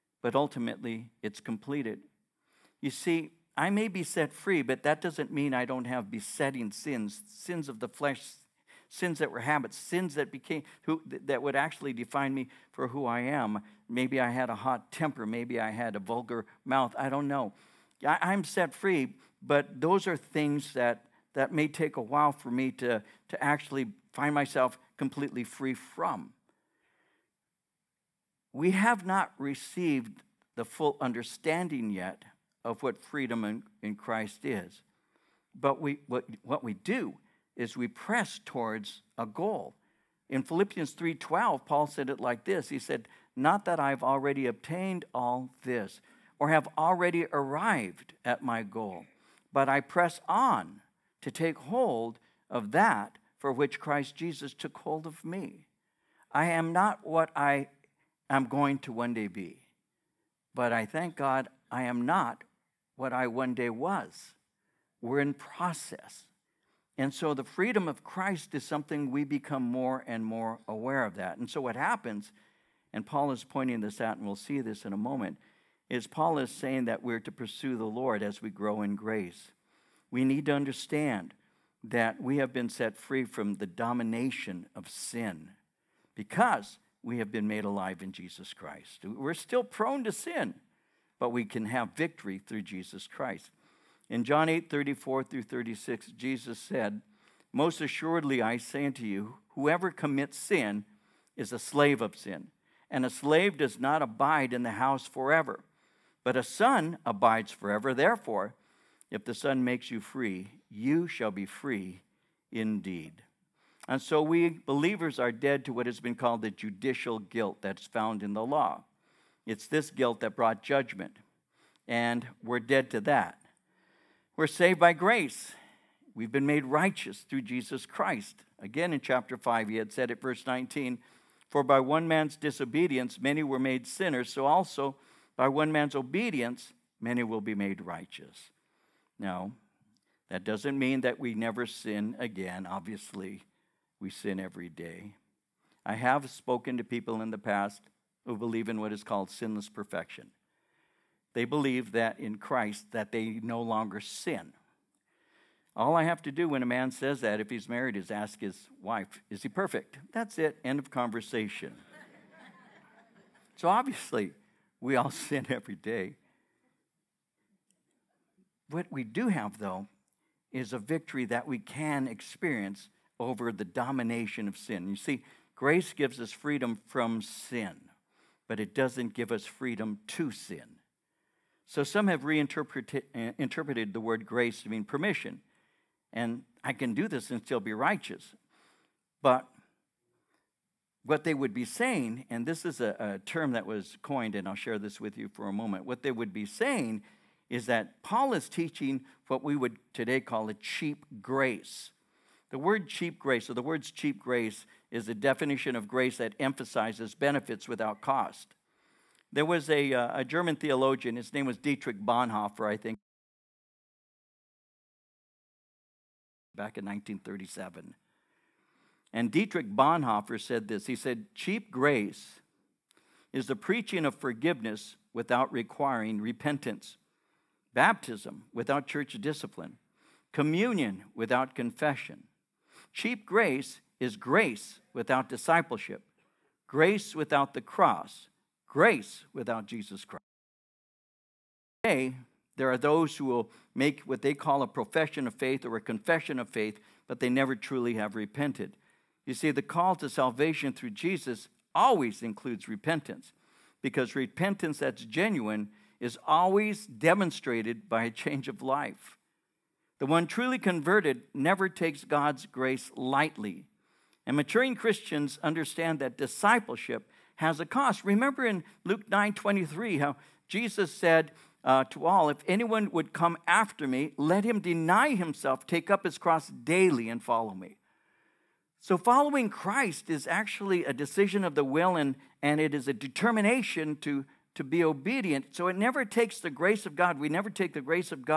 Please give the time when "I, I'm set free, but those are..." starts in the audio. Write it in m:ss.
0:18.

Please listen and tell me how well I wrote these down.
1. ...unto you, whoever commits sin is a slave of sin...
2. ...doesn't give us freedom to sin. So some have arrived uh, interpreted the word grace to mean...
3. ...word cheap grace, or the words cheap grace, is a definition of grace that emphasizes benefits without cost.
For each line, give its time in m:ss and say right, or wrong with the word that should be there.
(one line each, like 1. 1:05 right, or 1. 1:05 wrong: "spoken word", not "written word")
1. 1:38 right
2. 2:58 wrong: "reinterpreted", not "arrived"
3. 3:22 right.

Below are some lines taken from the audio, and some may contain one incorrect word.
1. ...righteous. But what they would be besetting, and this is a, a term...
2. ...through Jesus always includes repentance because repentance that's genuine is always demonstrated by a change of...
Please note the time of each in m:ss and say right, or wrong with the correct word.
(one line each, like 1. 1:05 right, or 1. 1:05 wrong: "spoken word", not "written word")
1. 3:07 wrong: "saying", not "besetting"
2. 4:10 right.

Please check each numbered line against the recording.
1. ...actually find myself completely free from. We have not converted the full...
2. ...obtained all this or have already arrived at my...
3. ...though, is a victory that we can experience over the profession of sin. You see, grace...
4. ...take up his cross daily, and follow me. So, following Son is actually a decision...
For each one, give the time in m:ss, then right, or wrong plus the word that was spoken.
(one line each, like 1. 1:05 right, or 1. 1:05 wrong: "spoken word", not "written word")
1. 0:23 wrong: "received", not "converted"
2. 0:44 right
3. 2:49 wrong: "domination", not "profession"
4. 4:35 wrong: "Christ", not "Son".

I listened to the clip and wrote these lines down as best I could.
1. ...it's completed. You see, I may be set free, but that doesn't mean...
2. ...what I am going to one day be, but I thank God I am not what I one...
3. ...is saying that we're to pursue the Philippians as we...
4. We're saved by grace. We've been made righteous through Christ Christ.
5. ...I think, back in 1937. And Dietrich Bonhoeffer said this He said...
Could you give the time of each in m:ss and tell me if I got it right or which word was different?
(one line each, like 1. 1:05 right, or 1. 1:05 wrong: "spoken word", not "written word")
1. 0:01 right
2. 0:57 right
3. 1:16 wrong: "Lord", not "Philippians"
4. 2:04 wrong: "Jesus", not "Christ"
5. 3:32 right.